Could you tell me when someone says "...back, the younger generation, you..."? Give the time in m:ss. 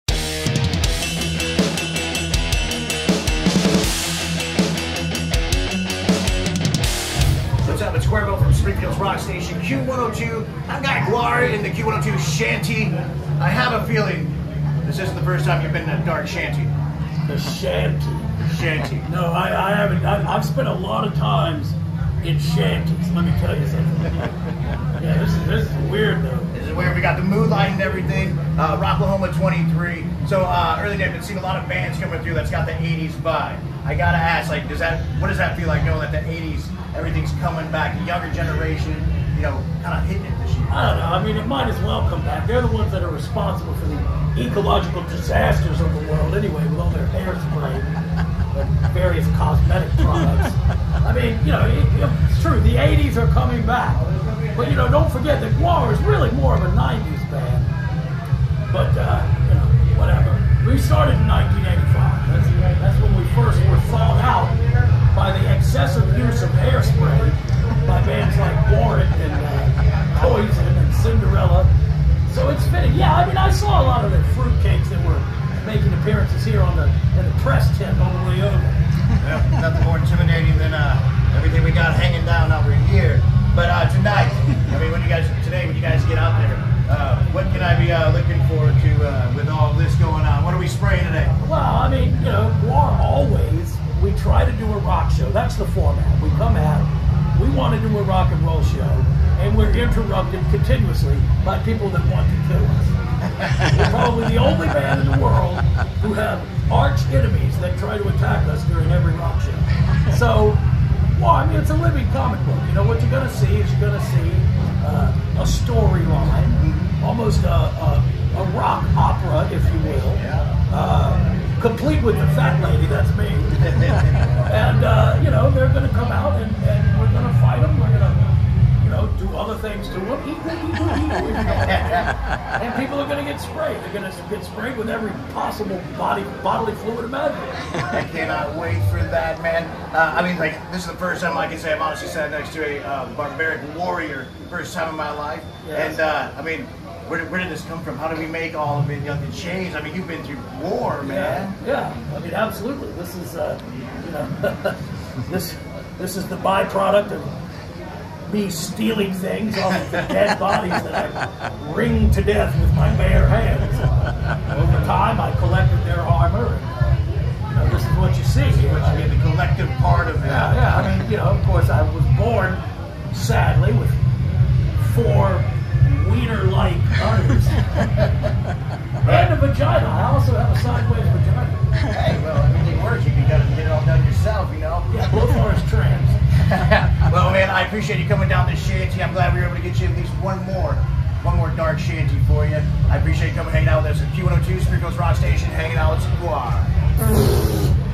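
0:37.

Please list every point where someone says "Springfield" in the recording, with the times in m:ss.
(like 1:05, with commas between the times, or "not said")
0:08, 3:14.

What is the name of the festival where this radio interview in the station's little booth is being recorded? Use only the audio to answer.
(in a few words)
Rocklahoma 23.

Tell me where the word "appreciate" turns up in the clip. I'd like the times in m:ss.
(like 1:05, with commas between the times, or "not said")
3:07, 3:12.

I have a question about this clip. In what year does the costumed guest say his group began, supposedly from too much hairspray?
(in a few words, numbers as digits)
1985.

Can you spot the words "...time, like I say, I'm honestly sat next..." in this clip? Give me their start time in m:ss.
2:21.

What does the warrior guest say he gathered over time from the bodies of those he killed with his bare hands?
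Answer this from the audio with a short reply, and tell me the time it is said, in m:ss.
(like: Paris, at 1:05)
armor, at 2:45.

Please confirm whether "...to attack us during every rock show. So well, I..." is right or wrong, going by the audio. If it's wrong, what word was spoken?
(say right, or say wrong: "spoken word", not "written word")
right.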